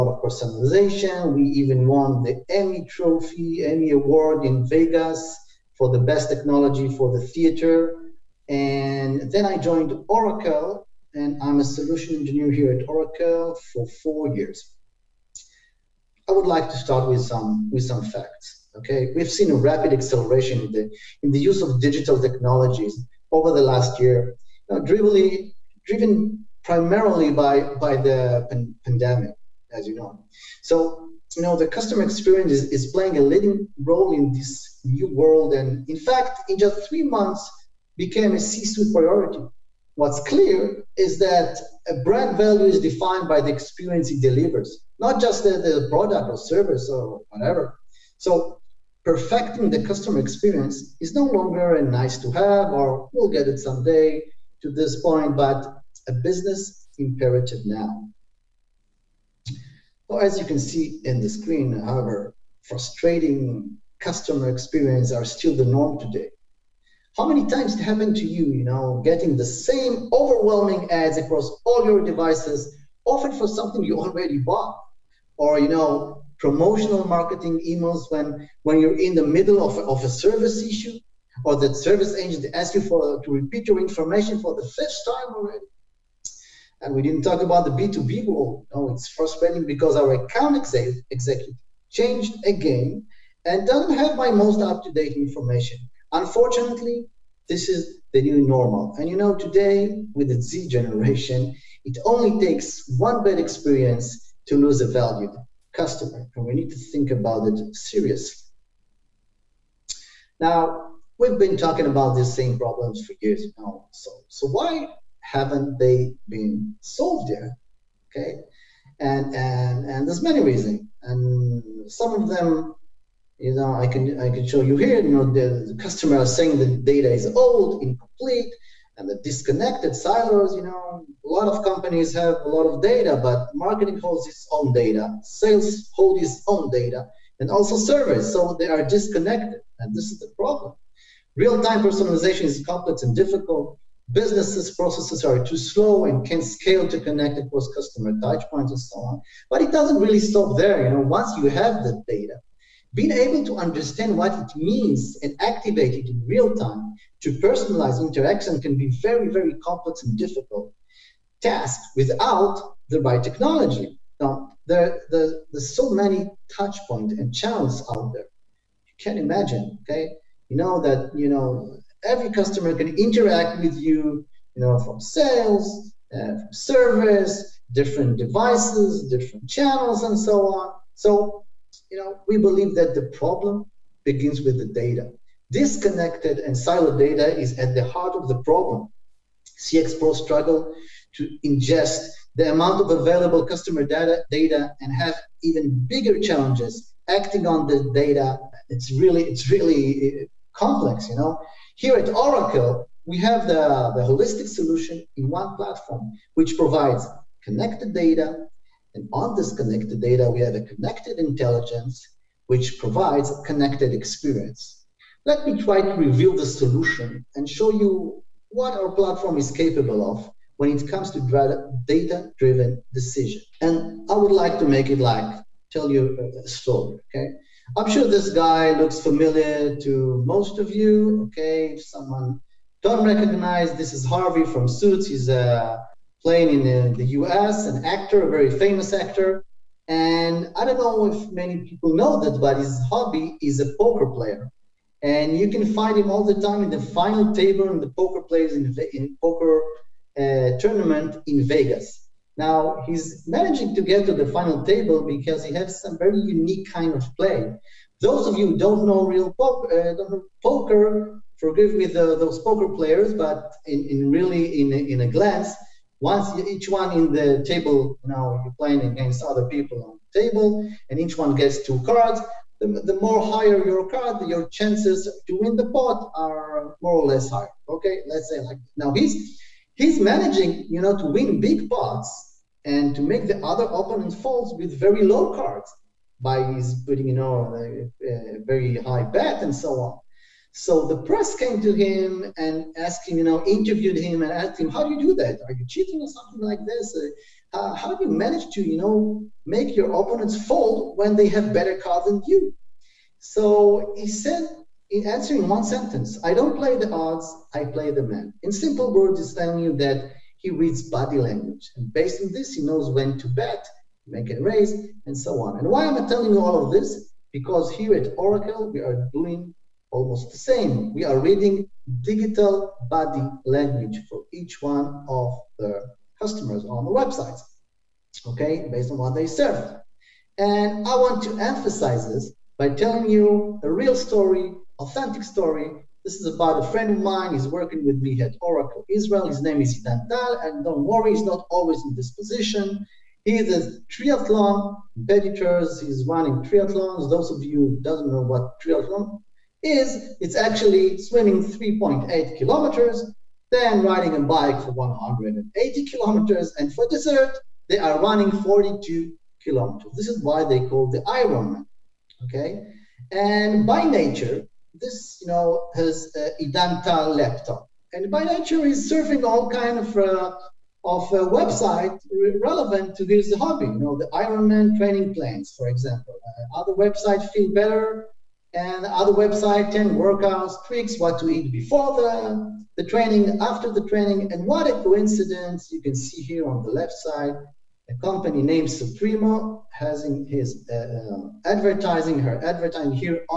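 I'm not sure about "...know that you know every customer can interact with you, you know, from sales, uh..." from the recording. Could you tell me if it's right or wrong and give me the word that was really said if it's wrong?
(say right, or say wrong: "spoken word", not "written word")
right.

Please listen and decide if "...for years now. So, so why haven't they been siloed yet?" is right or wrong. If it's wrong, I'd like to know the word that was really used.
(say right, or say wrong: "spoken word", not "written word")
wrong: "solved", not "siloed".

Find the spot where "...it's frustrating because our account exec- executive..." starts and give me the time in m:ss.
1:28.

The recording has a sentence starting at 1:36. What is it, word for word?
Unfortunately, this is the new normal.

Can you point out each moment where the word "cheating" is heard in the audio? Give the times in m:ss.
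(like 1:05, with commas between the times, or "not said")
4:55.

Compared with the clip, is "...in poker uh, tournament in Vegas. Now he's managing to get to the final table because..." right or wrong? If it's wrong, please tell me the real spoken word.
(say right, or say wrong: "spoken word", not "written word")
right.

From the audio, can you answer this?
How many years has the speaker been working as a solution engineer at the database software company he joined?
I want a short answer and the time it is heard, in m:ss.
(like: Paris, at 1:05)
4, at 0:14.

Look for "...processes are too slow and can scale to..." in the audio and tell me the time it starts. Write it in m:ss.
2:24.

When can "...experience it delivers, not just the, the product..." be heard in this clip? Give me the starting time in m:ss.
0:43.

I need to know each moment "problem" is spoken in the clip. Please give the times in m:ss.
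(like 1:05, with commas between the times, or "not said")
1:52, 2:20, 3:03, 3:08.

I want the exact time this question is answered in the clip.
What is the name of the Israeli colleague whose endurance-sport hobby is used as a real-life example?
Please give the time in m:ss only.
5:39.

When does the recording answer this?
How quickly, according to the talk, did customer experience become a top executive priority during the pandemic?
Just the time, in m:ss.
0:36.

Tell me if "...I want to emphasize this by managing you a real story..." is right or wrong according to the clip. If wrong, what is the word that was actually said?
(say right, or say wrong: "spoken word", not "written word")
wrong: "telling", not "managing".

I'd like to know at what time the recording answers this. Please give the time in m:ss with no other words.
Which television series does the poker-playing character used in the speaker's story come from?
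3:54.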